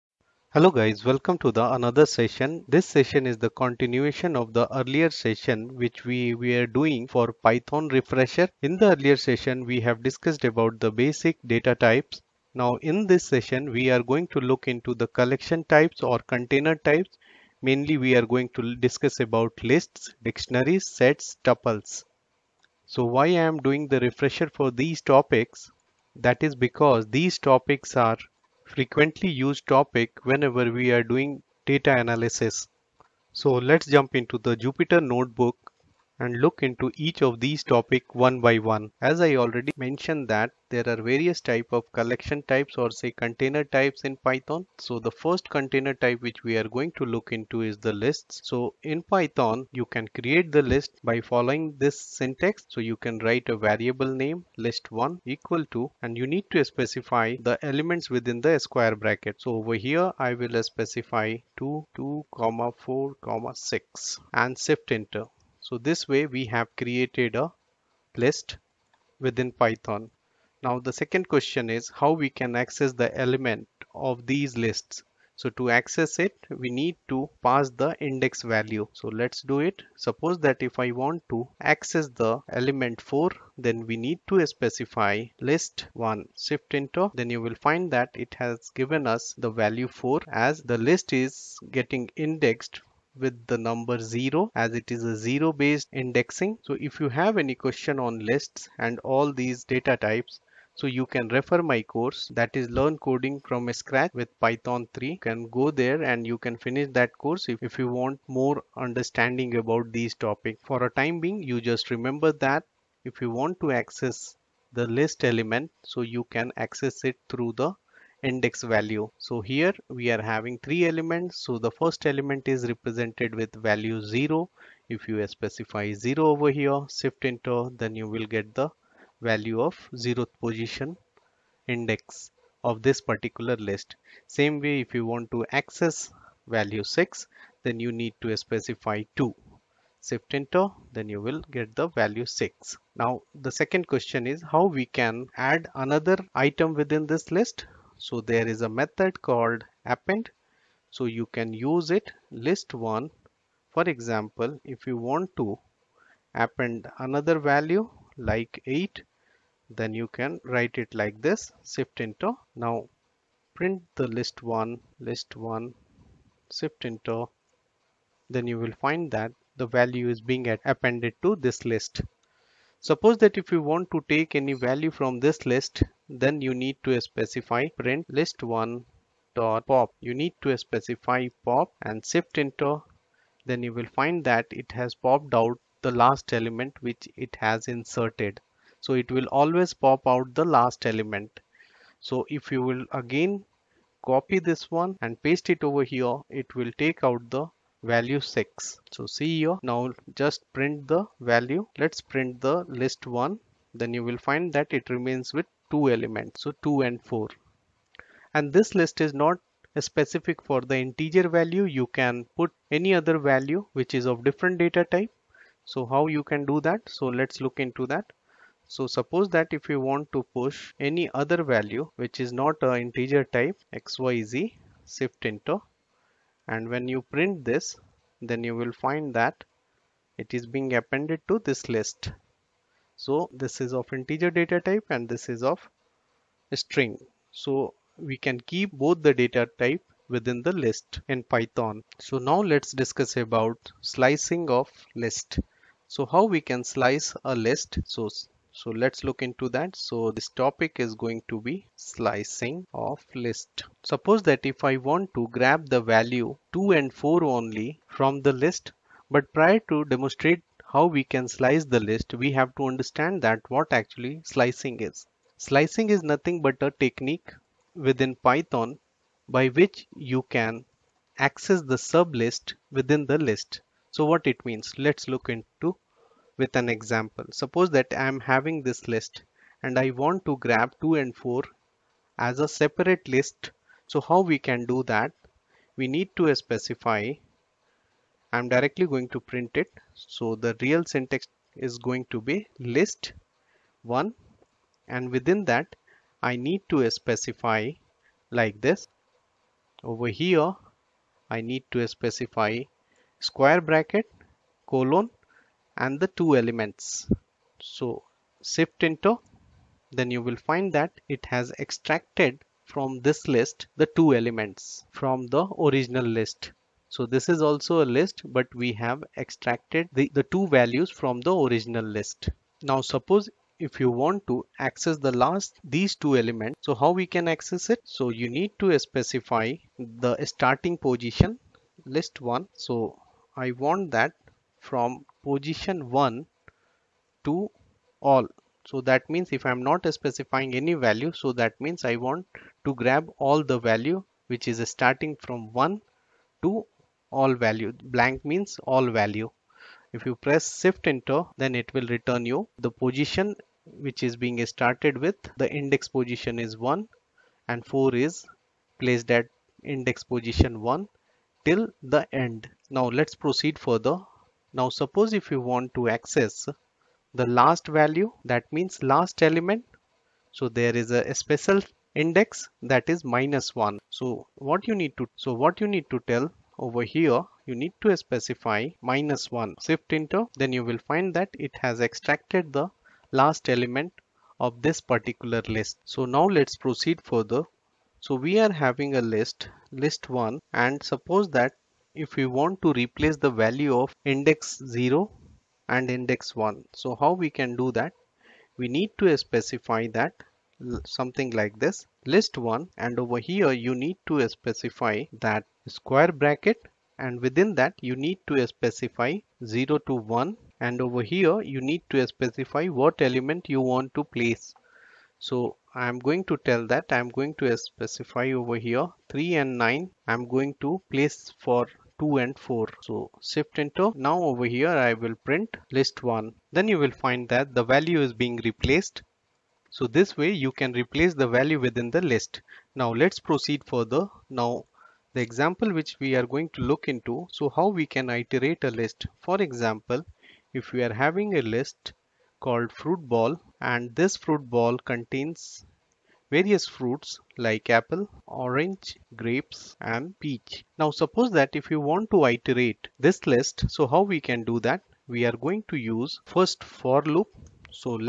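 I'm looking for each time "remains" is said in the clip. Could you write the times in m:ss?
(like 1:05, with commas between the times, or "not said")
3:24.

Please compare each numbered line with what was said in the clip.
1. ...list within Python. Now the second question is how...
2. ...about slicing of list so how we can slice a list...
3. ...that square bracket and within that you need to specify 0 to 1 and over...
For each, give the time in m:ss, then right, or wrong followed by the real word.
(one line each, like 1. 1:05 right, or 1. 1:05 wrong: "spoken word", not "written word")
1. 1:08 right
2. 4:03 right
3. 6:45 right.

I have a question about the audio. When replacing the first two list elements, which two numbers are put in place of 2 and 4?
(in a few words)
3 and 9.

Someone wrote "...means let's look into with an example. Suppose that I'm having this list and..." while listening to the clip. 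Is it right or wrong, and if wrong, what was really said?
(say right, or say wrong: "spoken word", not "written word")
right.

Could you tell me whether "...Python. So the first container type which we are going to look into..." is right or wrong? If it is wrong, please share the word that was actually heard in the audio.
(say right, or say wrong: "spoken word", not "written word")
right.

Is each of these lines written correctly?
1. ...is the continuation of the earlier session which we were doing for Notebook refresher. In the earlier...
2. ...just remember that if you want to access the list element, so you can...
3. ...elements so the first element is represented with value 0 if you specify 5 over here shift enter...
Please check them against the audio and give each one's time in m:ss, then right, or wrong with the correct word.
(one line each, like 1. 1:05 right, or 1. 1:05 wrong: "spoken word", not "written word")
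1. 0:03 wrong: "Python", not "Notebook"
2. 1:51 right
3. 2:00 wrong: "0", not "5".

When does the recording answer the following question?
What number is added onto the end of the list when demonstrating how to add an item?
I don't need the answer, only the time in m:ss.
2:38.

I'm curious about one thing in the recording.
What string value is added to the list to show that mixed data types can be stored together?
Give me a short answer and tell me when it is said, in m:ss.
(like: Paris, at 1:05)
xyz, at 3:43.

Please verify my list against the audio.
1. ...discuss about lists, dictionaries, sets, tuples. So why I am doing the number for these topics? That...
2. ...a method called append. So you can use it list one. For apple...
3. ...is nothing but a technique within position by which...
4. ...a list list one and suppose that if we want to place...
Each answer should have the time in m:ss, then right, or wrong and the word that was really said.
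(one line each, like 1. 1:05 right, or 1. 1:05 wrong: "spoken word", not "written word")
1. 0:18 wrong: "refresher", not "number"
2. 2:28 wrong: "example", not "apple"
3. 4:25 wrong: "python", not "position"
4. 6:28 wrong: "replace", not "place".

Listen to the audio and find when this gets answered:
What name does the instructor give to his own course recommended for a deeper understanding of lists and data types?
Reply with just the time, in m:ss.
1:42.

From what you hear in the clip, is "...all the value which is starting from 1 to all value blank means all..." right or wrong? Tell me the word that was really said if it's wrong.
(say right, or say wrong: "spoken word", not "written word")
right.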